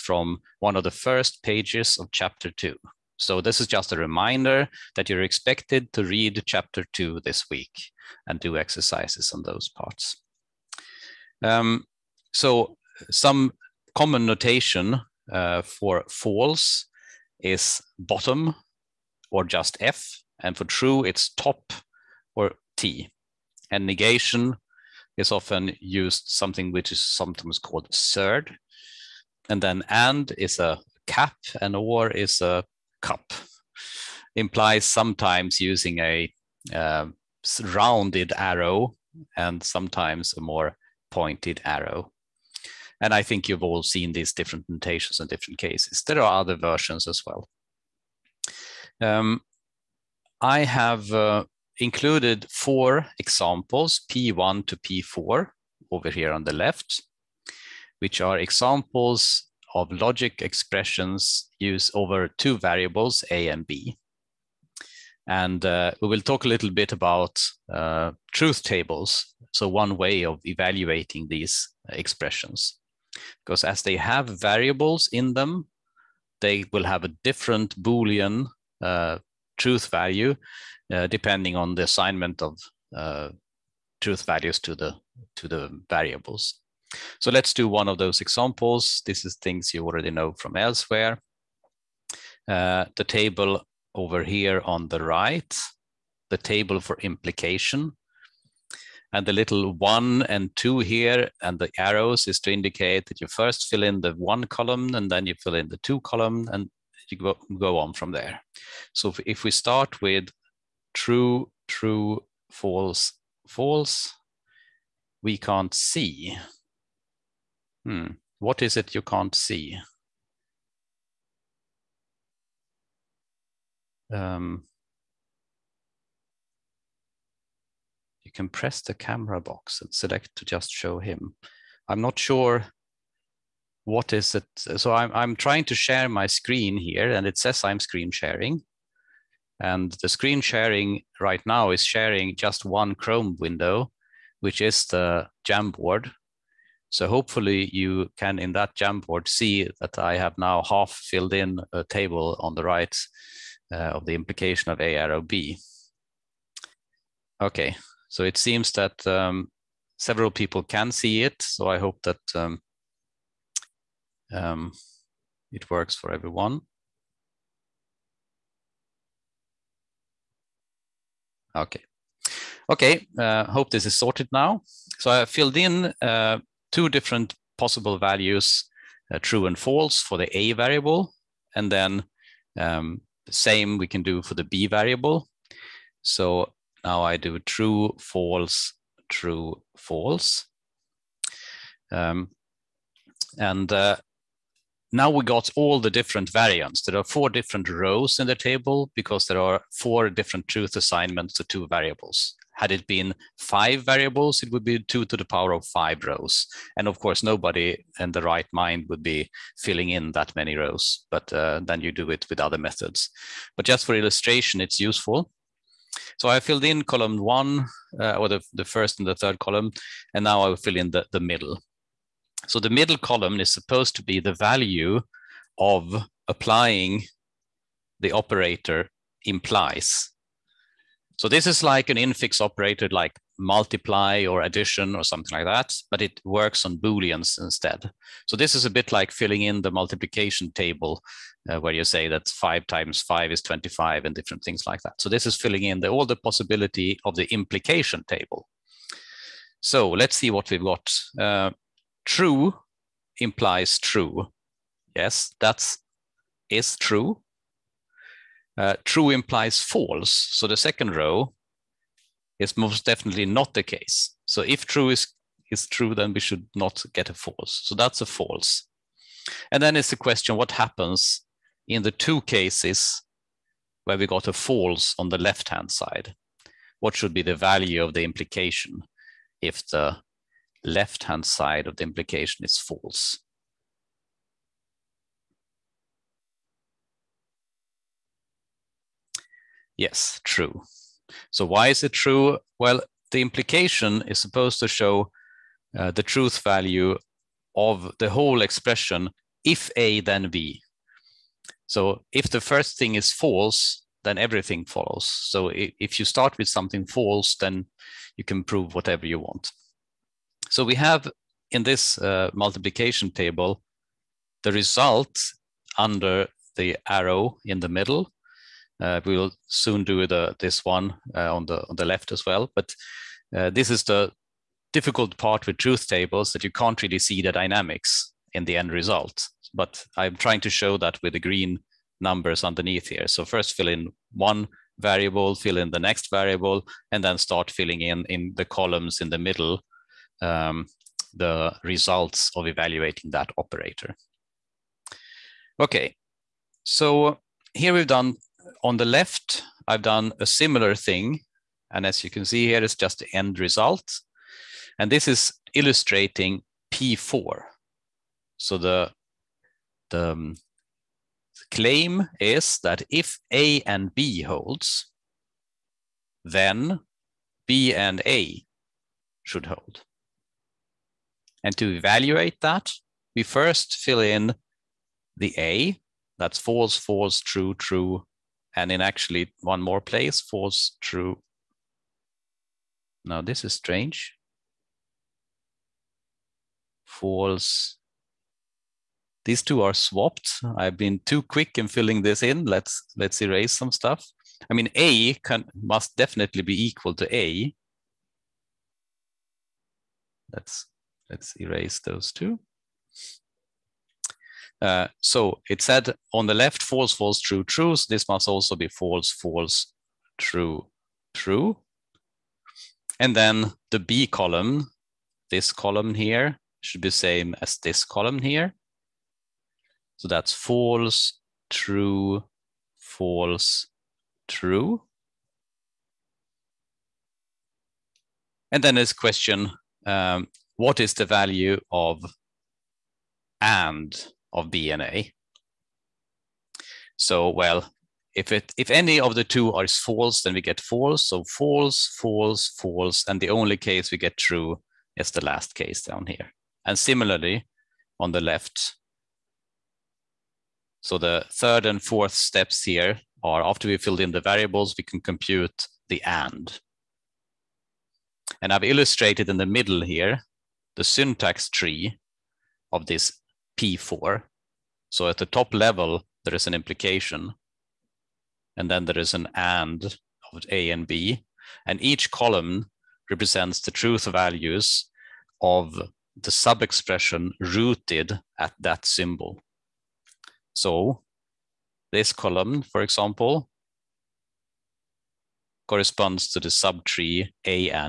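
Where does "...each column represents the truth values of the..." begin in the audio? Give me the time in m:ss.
7:51.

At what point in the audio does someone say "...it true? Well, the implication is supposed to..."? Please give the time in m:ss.
4:51.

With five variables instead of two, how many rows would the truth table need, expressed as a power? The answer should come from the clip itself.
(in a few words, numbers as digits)
2 to the power of 5.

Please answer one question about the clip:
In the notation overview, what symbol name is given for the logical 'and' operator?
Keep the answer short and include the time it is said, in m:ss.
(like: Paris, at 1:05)
cap, at 0:31.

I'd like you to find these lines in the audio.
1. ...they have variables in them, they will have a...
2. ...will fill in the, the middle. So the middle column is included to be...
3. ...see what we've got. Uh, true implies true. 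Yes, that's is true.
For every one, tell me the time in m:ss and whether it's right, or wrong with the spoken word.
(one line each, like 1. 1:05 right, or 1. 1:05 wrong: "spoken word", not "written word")
1. 1:13 right
2. 3:40 wrong: "supposed", not "included"
3. 4:10 right.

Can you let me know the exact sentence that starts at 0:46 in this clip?
There are other versions as well.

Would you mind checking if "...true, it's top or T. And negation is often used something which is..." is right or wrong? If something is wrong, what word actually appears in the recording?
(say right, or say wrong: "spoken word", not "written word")
right.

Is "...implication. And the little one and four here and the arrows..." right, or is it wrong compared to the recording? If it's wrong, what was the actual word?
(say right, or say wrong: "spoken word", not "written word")
wrong: "two", not "four".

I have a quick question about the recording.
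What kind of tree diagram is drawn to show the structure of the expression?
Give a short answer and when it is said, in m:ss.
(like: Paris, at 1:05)
syntax tree, at 7:40.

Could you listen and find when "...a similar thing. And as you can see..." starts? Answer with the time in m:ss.
5:50.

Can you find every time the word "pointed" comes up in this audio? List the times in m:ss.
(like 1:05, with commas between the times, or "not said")
0:41.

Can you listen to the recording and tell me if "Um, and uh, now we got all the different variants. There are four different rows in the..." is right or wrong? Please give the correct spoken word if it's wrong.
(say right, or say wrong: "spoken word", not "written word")
right.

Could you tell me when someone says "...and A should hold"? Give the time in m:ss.
6:07.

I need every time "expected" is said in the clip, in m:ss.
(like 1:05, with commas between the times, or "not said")
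0:05.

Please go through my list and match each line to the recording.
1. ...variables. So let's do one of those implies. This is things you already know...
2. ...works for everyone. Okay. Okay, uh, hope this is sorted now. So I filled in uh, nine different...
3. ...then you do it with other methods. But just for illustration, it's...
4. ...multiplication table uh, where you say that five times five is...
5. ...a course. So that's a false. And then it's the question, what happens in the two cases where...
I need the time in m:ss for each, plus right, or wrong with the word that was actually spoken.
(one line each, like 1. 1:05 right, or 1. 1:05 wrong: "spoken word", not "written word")
1. 1:25 wrong: "examples", not "implies"
2. 2:45 wrong: "two", not "nine"
3. 3:31 right
4. 3:59 right
5. 4:27 wrong: "false", not "course".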